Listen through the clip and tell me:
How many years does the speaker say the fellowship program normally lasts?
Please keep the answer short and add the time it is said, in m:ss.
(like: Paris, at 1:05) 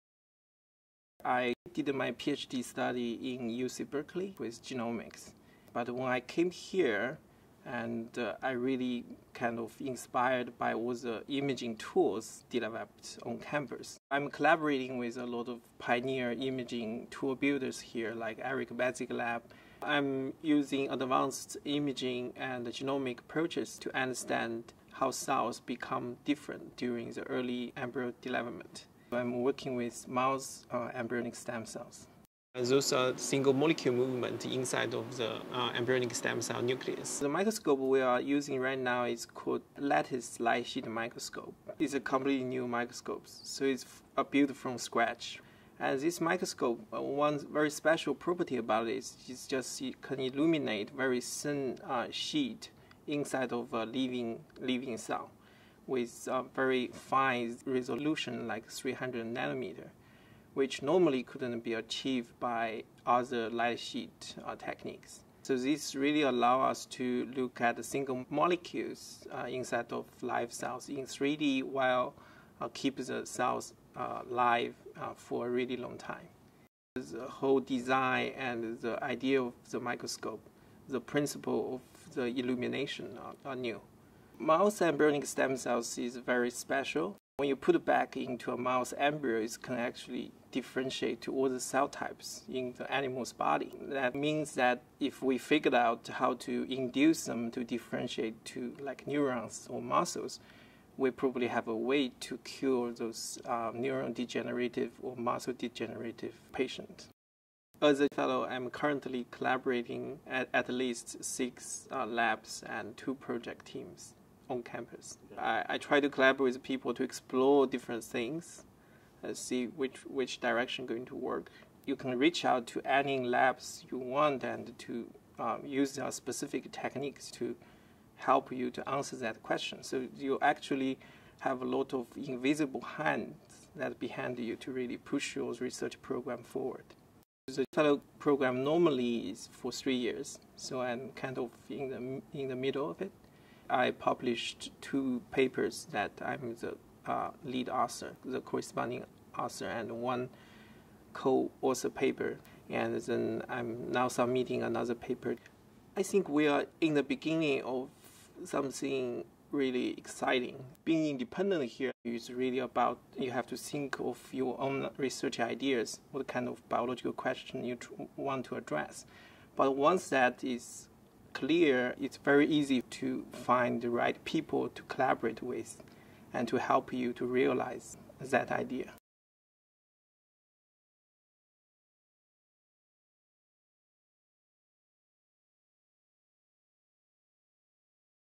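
3, at 2:19.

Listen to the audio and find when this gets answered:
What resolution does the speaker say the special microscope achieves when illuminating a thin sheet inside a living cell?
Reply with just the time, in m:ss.
0:58.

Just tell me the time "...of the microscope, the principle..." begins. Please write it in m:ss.
1:19.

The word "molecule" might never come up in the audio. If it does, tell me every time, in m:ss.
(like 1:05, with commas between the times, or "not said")
0:33, 1:08.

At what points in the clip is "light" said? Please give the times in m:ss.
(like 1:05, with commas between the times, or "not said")
0:40, 1:03.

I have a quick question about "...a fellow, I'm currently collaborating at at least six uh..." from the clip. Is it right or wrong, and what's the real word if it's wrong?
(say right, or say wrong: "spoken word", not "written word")
right.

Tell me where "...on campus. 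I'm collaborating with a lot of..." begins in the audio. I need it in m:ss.
0:13.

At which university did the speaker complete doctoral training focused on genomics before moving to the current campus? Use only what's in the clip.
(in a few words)
UC Berkeley.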